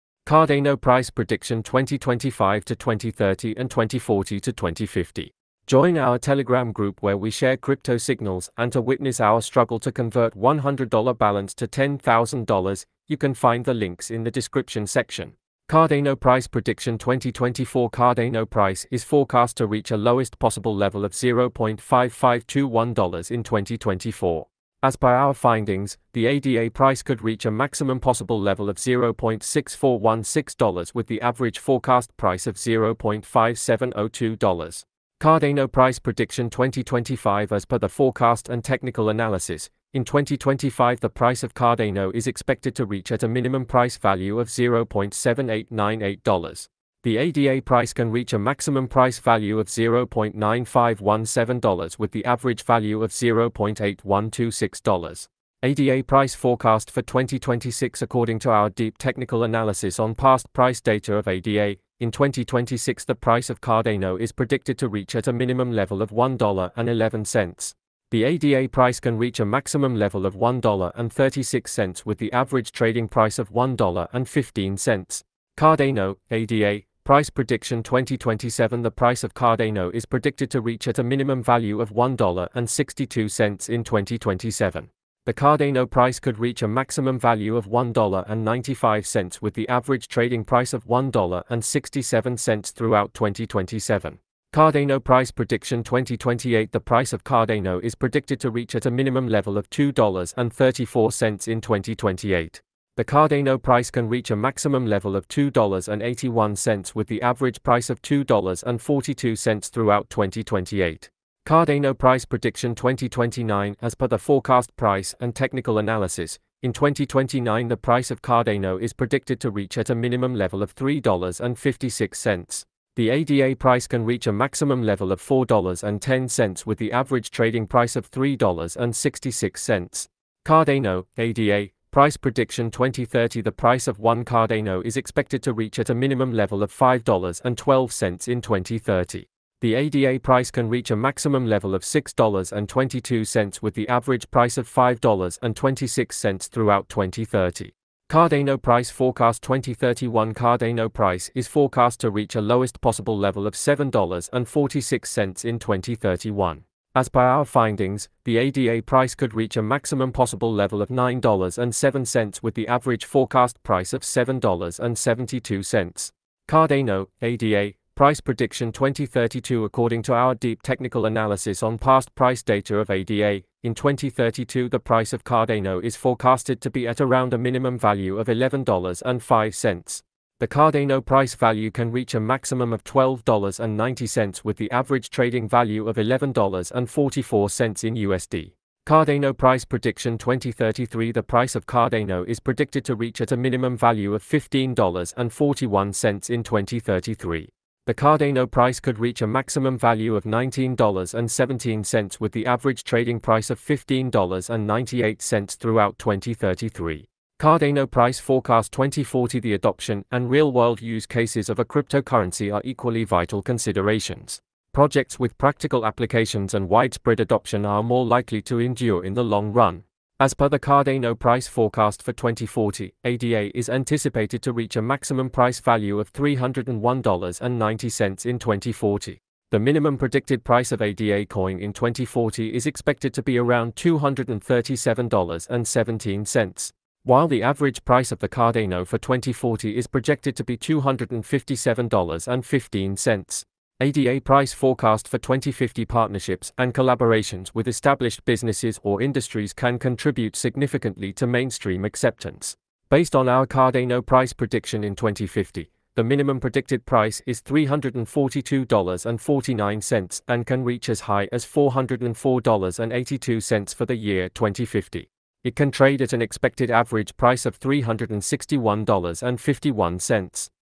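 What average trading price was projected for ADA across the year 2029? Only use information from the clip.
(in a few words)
$3.66.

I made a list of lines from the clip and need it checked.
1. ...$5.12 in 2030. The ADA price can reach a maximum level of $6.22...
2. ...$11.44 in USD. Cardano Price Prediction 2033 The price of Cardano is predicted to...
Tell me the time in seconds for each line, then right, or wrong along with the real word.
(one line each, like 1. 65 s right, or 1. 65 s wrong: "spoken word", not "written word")
1. 136 s right
2. 185 s right.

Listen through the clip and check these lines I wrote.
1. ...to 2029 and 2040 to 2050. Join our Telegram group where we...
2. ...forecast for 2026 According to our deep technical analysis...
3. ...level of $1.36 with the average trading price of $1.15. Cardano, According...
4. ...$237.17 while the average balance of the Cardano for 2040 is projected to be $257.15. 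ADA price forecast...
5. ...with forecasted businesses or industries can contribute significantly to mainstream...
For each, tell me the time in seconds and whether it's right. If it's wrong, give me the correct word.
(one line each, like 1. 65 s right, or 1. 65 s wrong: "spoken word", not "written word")
1. 2 s wrong: "2030", not "2029"
2. 56 s right
3. 69 s wrong: "ADA", not "According"
4. 233 s wrong: "price", not "balance"
5. 247 s wrong: "established", not "forecasted".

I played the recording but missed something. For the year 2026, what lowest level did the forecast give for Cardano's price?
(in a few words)
$1.11.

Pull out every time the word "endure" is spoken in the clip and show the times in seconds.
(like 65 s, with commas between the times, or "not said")
218 s.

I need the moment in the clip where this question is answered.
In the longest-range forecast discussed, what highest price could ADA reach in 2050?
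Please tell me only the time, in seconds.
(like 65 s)
261 s.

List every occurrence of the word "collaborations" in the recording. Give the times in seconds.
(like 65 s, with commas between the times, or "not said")
246 s.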